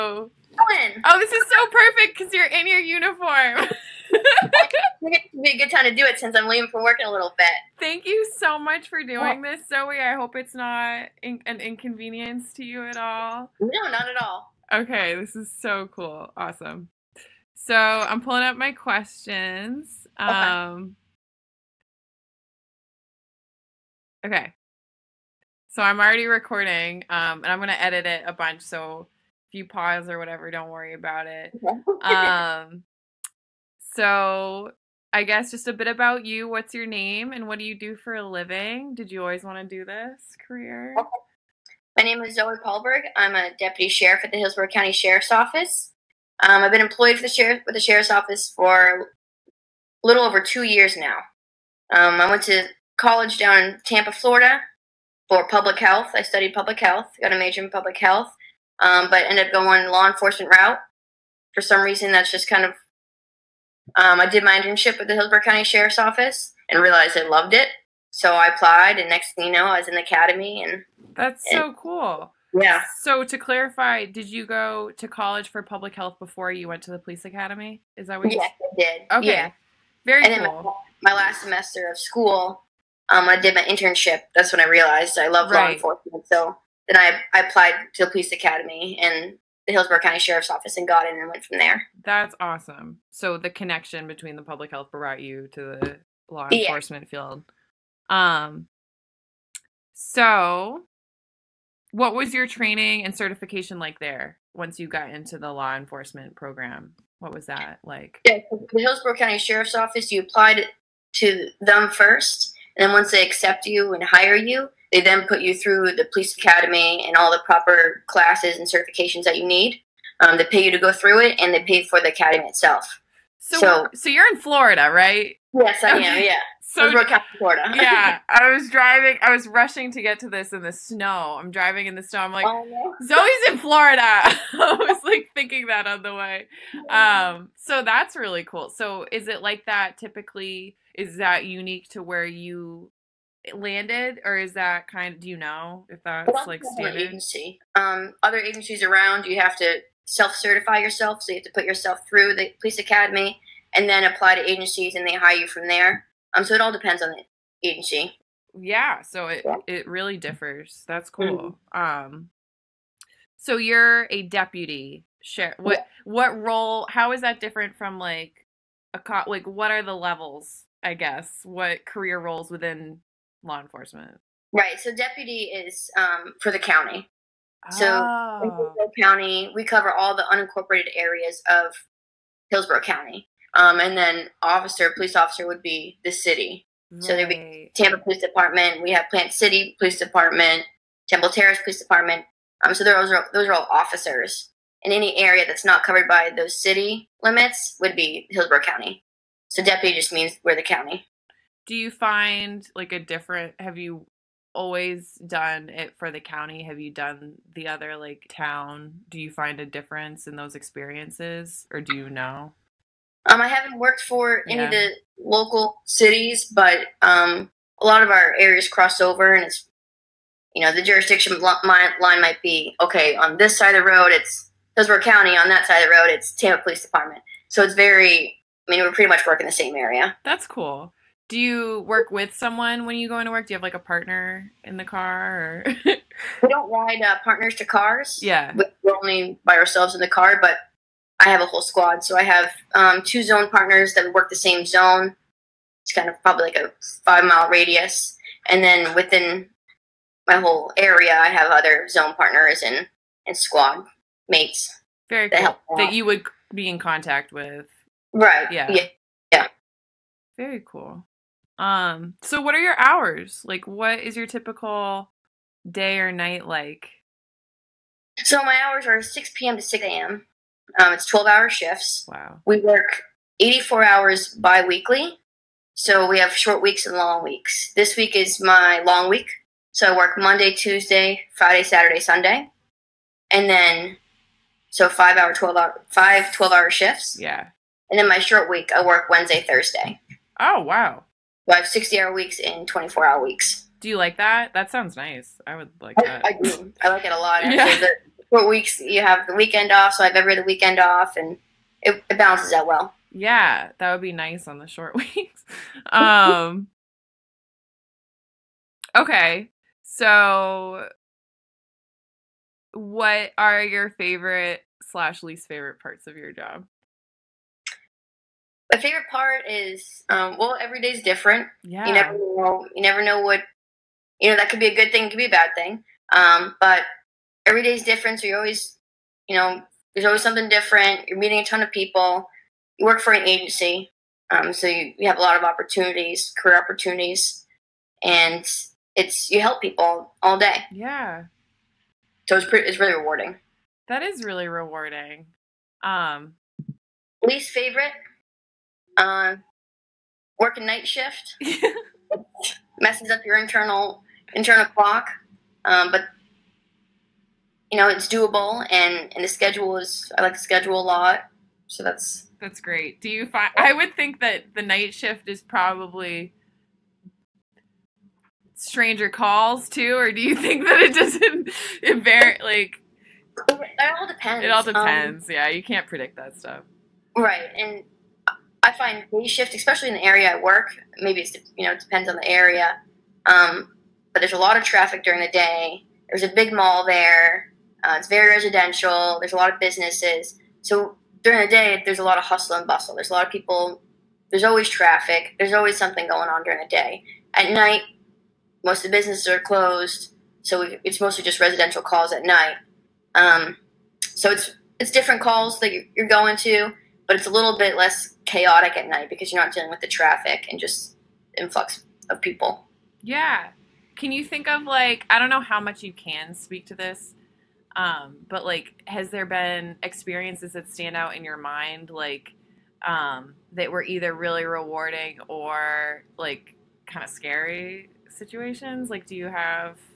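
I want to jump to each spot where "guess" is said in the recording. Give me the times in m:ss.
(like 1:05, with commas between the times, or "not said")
0:35, 2:50.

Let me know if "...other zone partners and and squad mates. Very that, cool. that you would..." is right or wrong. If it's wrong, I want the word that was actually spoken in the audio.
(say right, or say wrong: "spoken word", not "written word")
right.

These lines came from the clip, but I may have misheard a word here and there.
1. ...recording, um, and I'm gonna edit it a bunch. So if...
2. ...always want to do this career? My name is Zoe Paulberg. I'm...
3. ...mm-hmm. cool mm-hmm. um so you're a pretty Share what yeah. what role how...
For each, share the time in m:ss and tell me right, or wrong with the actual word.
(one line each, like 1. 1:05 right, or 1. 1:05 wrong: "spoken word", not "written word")
1. 0:26 right
2. 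0:39 right
3. 2:41 wrong: "deputy", not "pretty".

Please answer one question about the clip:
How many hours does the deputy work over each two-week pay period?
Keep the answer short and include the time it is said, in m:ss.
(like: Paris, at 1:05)
84, at 4:32.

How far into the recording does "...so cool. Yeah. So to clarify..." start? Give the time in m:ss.
1:11.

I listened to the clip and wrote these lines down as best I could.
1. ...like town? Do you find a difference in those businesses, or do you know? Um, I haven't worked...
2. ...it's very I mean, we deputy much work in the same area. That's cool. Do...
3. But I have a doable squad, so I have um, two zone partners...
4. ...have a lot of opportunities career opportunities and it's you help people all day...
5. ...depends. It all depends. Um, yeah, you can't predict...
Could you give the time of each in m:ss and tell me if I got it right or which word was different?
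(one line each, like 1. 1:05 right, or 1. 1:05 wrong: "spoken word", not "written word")
1. 3:27 wrong: "experiences", not "businesses"
2. 3:47 wrong: "pretty", not "deputy"
3. 4:00 wrong: "whole", not "doable"
4. 5:35 right
5. 6:14 right.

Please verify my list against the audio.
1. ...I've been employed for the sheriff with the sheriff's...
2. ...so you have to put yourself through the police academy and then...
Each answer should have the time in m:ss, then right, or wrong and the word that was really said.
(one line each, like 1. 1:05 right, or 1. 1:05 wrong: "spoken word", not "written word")
1. 0:46 right
2. 2:31 right.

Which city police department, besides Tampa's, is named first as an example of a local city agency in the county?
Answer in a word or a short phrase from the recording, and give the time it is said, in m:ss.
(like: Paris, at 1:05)
Plant City Police Department, at 3:09.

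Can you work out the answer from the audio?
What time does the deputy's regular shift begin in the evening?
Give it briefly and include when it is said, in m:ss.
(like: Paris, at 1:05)
6 p.m., at 4:29.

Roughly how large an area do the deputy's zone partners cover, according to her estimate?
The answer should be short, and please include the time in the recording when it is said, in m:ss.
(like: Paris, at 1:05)
5 mile radius, at 4:07.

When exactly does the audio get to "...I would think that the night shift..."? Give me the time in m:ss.
6:03.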